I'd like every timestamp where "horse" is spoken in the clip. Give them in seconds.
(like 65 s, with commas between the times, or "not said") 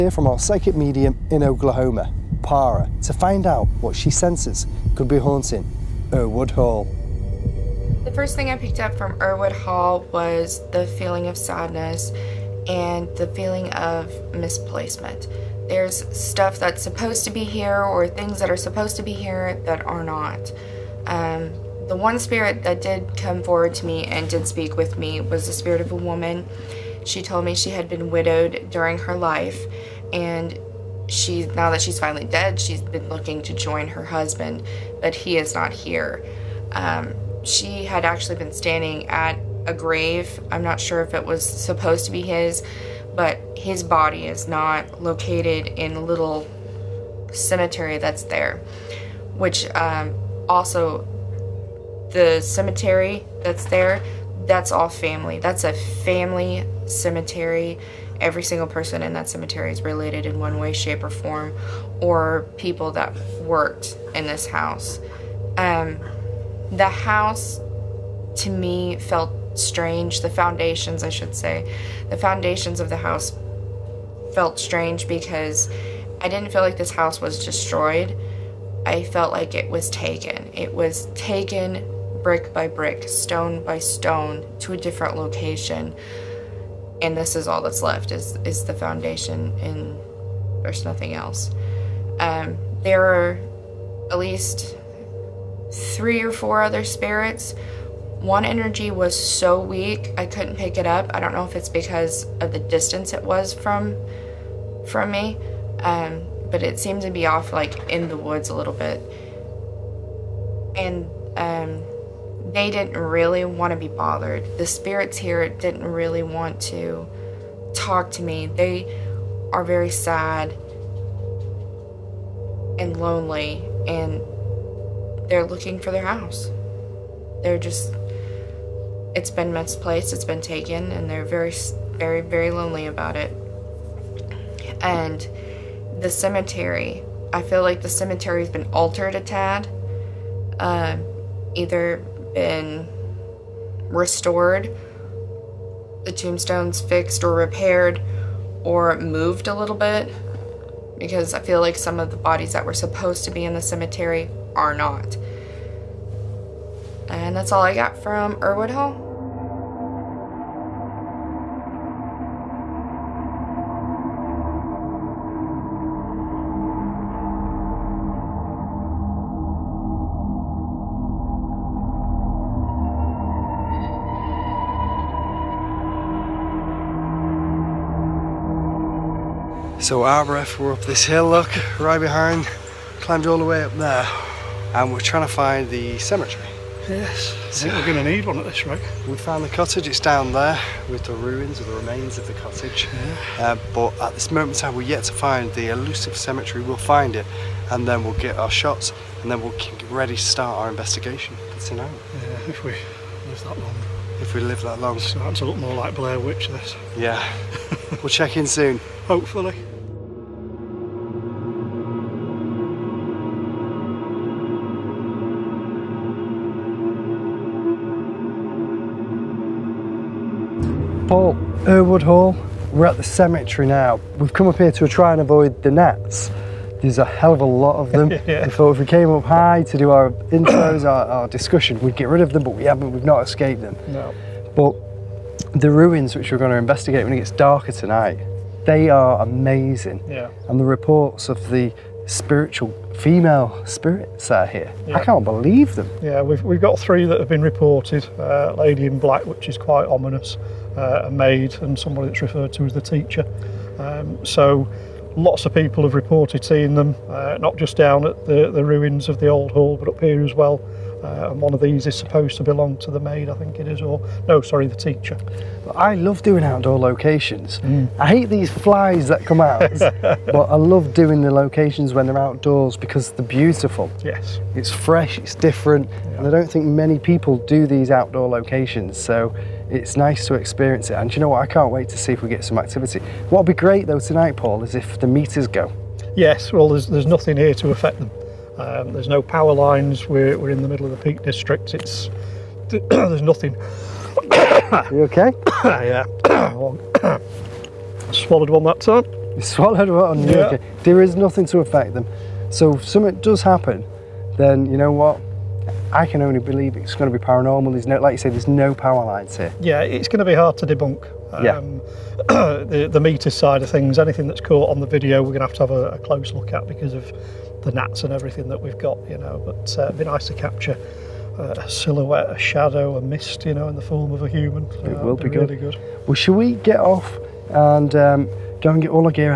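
not said.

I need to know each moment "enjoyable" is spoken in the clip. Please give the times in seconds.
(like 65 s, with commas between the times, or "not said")
not said.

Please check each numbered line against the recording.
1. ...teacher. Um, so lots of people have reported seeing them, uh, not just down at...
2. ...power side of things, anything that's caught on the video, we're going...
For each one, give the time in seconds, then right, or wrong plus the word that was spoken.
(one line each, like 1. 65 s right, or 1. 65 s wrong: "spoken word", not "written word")
1. 252 s right
2. 312 s wrong: "meter", not "power".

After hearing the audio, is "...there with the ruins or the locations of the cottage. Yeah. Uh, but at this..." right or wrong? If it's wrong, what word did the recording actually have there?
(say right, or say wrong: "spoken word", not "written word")
wrong: "remains", not "locations".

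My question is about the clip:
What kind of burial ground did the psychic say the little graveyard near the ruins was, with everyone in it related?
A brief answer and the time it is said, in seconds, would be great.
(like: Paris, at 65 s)
A family cemetery, at 55 s.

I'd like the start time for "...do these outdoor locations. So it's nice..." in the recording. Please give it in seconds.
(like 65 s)
277 s.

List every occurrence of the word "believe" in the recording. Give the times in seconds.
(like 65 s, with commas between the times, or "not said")
245 s, 306 s.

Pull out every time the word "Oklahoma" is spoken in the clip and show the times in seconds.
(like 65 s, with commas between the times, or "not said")
1 s.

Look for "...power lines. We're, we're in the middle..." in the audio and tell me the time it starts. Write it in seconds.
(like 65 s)
289 s.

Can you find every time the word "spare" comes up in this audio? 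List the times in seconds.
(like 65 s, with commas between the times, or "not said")
not said.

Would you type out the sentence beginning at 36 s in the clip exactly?
Um, she had actually been standing at a grave.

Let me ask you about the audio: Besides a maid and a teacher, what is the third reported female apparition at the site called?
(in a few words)
Lady in Black.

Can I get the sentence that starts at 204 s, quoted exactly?
It's starting to look more like Blair Witch, this.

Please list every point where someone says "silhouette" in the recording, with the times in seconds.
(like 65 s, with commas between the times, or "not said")
321 s.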